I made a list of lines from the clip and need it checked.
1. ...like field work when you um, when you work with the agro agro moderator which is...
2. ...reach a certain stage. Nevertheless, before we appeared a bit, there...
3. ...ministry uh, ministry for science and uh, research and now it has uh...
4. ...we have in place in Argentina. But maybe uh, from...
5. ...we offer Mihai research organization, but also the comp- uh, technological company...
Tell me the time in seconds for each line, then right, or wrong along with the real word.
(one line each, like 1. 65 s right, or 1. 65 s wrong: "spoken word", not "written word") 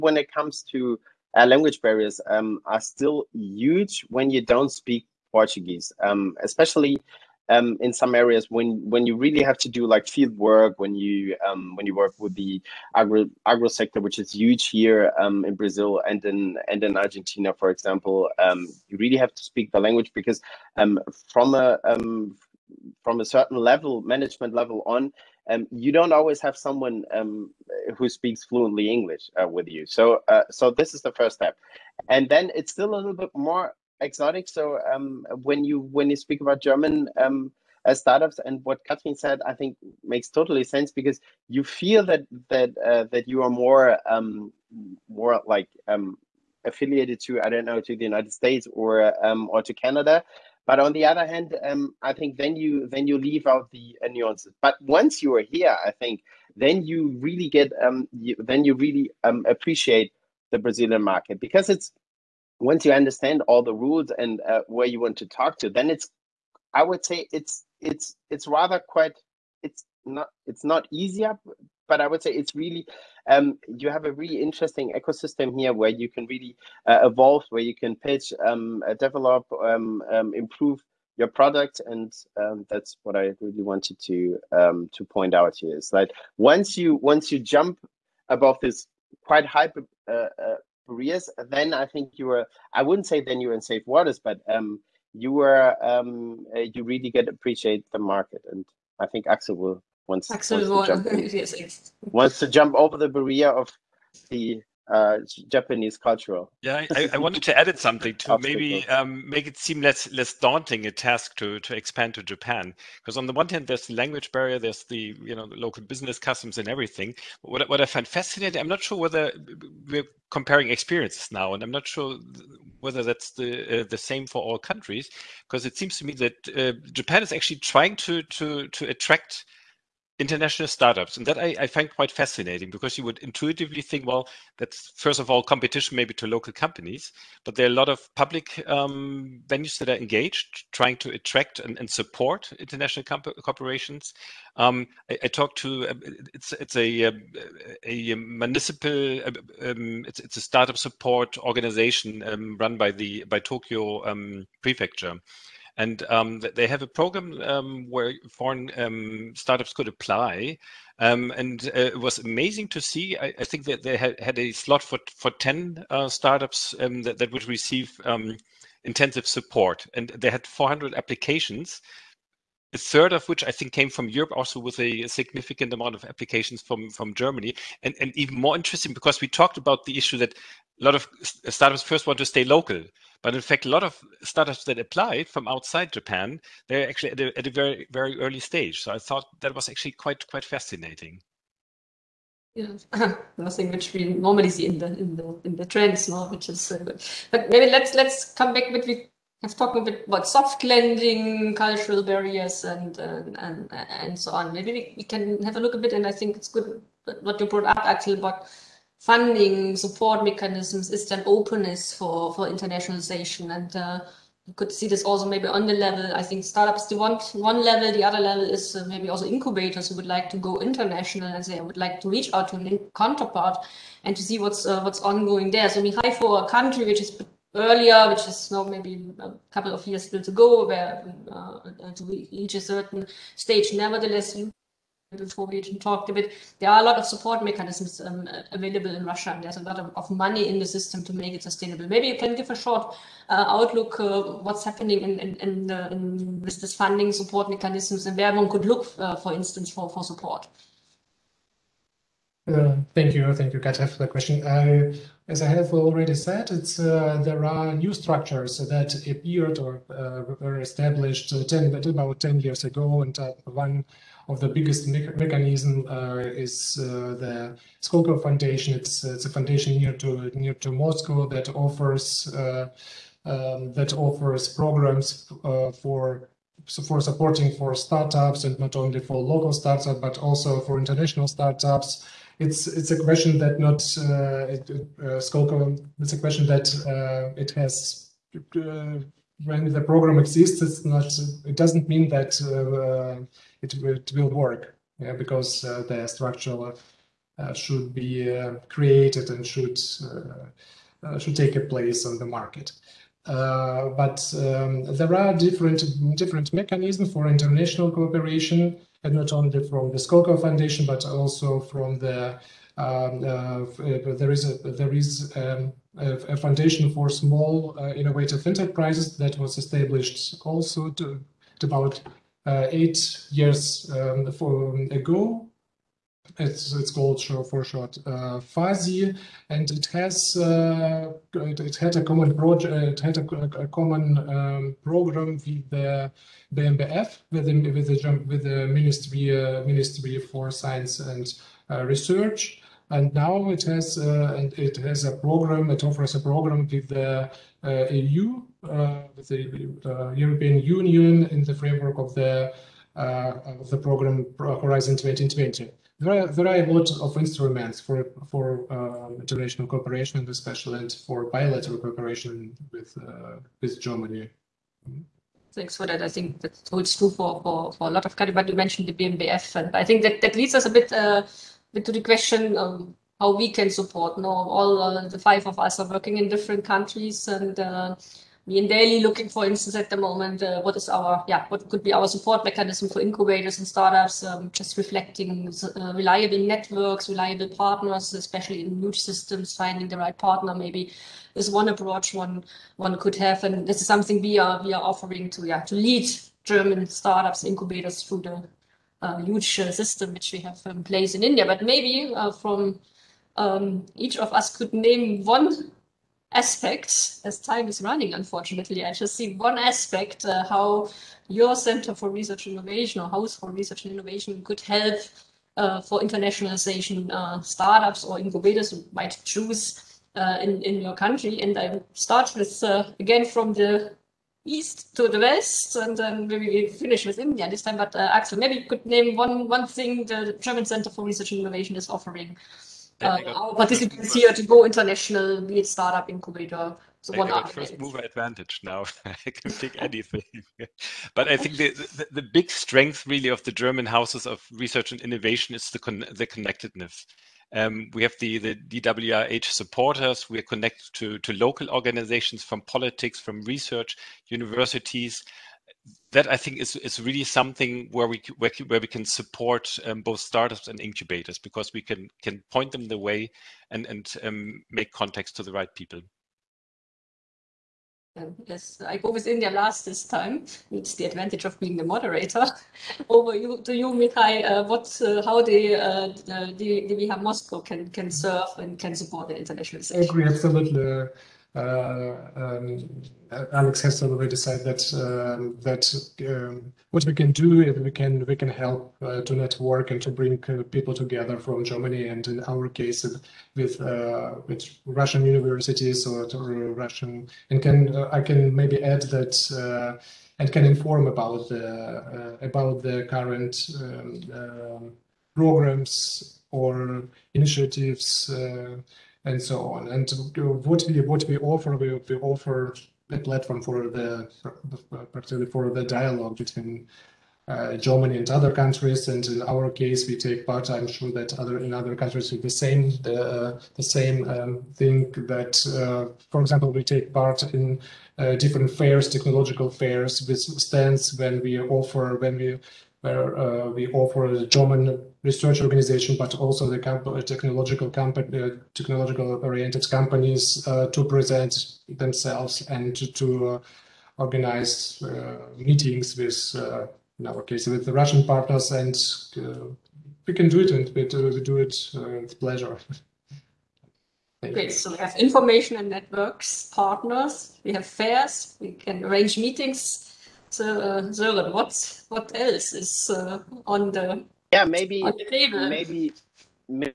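1. 9 s wrong: "sector", not "moderator"
2. 232 s wrong: "talked", not "appeared"
3. 338 s right
4. 400 s wrong: "India", not "Argentina"
5. 533 s wrong: "German", not "Mihai".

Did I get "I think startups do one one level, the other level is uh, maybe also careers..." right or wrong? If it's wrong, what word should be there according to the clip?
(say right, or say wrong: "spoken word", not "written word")
wrong: "incubators", not "careers".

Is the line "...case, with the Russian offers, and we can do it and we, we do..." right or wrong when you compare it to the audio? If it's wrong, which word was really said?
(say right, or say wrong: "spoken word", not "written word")
wrong: "partners", not "offers".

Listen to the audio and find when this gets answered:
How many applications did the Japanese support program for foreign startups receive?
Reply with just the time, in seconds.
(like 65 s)
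170 s.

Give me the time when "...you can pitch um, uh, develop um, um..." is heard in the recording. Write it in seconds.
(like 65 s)
77 s.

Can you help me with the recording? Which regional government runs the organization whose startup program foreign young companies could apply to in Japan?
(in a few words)
Tokyo prefecture.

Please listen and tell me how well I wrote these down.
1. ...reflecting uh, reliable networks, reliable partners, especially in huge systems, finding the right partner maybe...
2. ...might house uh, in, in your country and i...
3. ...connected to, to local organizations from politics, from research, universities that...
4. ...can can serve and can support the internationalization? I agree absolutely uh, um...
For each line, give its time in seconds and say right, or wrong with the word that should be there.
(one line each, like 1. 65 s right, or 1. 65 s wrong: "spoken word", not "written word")
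1. 384 s right
2. 418 s wrong: "choose", not "house"
3. 450 s right
4. 477 s right.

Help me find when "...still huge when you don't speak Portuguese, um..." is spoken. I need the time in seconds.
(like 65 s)
2 s.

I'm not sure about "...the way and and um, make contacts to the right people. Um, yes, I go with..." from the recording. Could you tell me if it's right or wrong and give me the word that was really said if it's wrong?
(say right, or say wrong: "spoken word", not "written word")
right.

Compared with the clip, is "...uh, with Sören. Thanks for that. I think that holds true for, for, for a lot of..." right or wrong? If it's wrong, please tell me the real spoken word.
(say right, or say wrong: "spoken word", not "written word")
wrong: "Germany", not "Sören".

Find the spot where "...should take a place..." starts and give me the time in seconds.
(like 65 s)
301 s.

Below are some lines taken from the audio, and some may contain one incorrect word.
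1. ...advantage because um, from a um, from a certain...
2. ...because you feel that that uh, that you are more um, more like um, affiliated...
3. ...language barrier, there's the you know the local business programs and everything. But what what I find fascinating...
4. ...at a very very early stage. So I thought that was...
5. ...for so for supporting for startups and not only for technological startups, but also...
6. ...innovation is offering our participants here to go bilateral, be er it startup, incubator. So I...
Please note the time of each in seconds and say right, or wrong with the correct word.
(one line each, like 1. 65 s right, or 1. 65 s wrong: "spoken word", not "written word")
1. 19 s wrong: "language", not "advantage"
2. 40 s right
3. 113 s wrong: "customs", not "programs"
4. 187 s right
5. 275 s wrong: "local", not "technological"
6. 431 s wrong: "international", not "bilateral".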